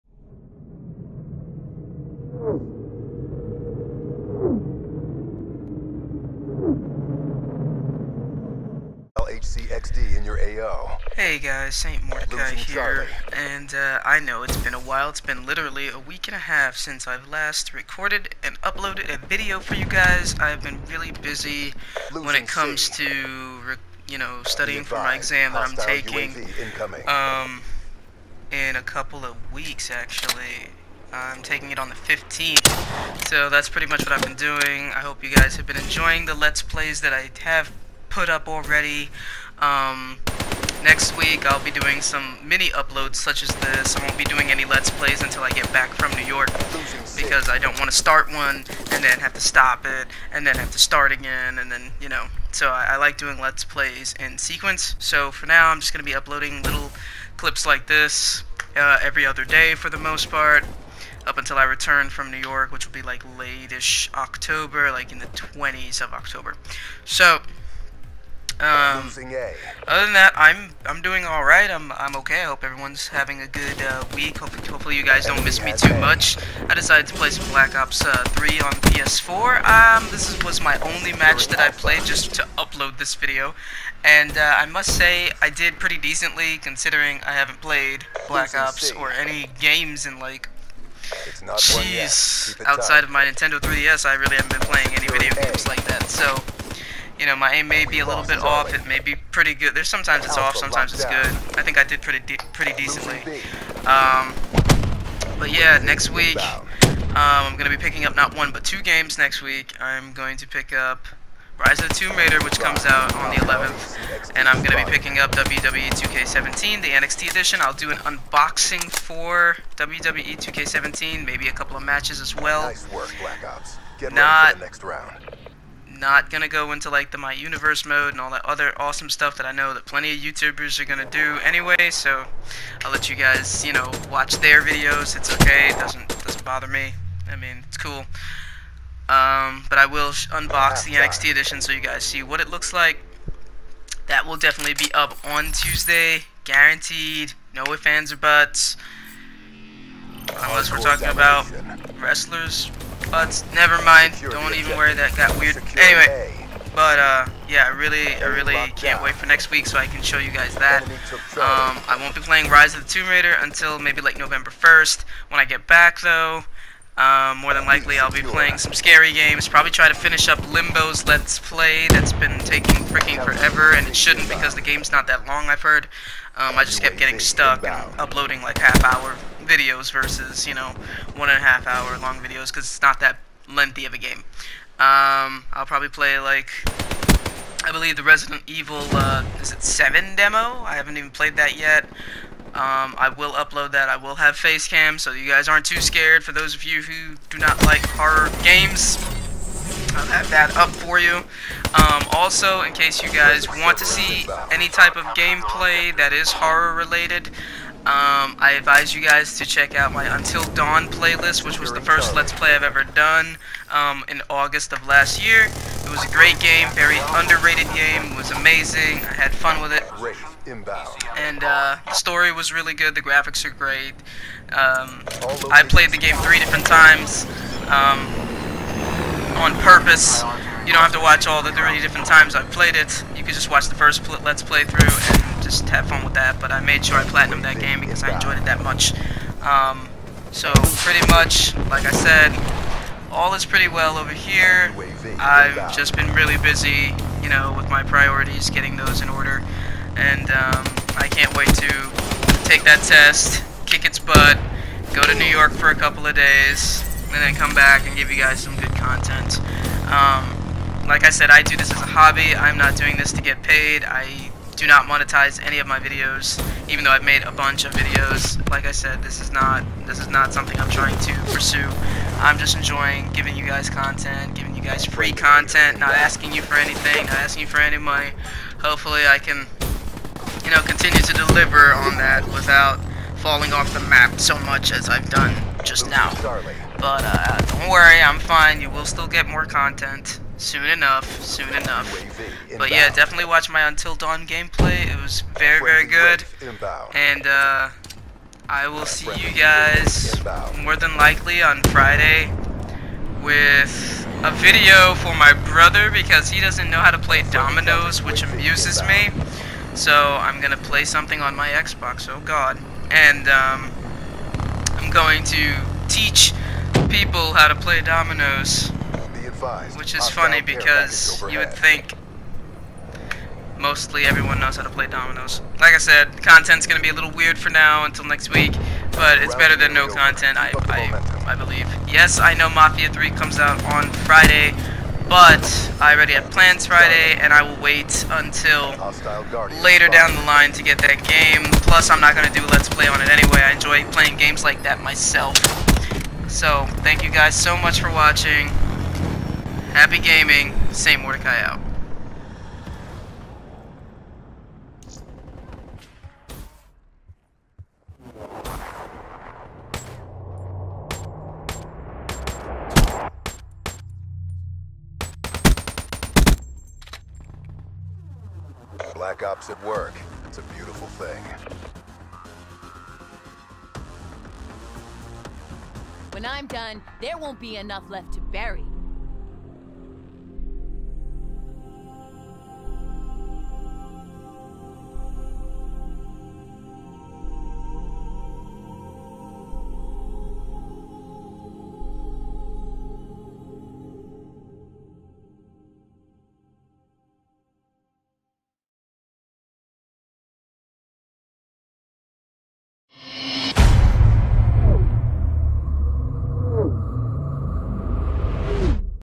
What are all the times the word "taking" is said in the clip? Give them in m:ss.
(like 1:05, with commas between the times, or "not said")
0:25, 0:31, 2:52.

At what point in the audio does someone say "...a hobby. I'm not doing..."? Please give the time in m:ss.
4:21.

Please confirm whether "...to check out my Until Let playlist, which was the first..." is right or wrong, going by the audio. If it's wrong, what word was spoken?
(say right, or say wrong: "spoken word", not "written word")
wrong: "Dawn", not "Let".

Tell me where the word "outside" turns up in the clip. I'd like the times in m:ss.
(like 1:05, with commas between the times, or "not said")
1:32.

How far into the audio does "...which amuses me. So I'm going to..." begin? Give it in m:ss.
5:08.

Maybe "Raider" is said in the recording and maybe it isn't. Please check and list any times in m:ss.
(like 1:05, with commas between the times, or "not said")
1:52, 2:43.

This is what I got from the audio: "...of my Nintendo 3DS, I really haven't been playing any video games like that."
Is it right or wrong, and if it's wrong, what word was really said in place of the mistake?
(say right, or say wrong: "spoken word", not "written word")
right.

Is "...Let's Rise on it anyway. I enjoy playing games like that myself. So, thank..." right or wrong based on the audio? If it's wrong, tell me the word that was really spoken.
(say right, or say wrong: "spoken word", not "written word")
wrong: "Play", not "Rise".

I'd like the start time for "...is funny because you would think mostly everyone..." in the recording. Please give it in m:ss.
5:19.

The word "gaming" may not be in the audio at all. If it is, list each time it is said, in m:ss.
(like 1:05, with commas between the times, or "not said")
5:49.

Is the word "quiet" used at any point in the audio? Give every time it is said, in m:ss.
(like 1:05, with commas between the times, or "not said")
not said.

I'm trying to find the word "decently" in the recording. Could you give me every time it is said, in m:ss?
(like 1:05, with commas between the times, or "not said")
1:25, 1:42.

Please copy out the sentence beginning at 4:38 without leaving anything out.
Hopefully I can, you know, continue to deliver on that without falling off the map so much as I've done just now.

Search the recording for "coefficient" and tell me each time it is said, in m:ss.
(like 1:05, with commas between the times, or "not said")
not said.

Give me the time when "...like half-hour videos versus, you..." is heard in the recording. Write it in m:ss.
2:58.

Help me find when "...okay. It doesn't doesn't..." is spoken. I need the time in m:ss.
2:15.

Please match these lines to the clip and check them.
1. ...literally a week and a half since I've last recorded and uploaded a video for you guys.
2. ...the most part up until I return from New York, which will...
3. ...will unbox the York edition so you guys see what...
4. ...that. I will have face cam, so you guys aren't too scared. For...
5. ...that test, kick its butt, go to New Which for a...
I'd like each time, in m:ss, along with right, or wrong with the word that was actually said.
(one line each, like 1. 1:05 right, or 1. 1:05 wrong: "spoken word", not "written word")
1. 0:15 right
2. 0:59 right
3. 2:19 wrong: "NXT", not "York"
4. 3:13 right
5. 4:12 wrong: "York", not "Which".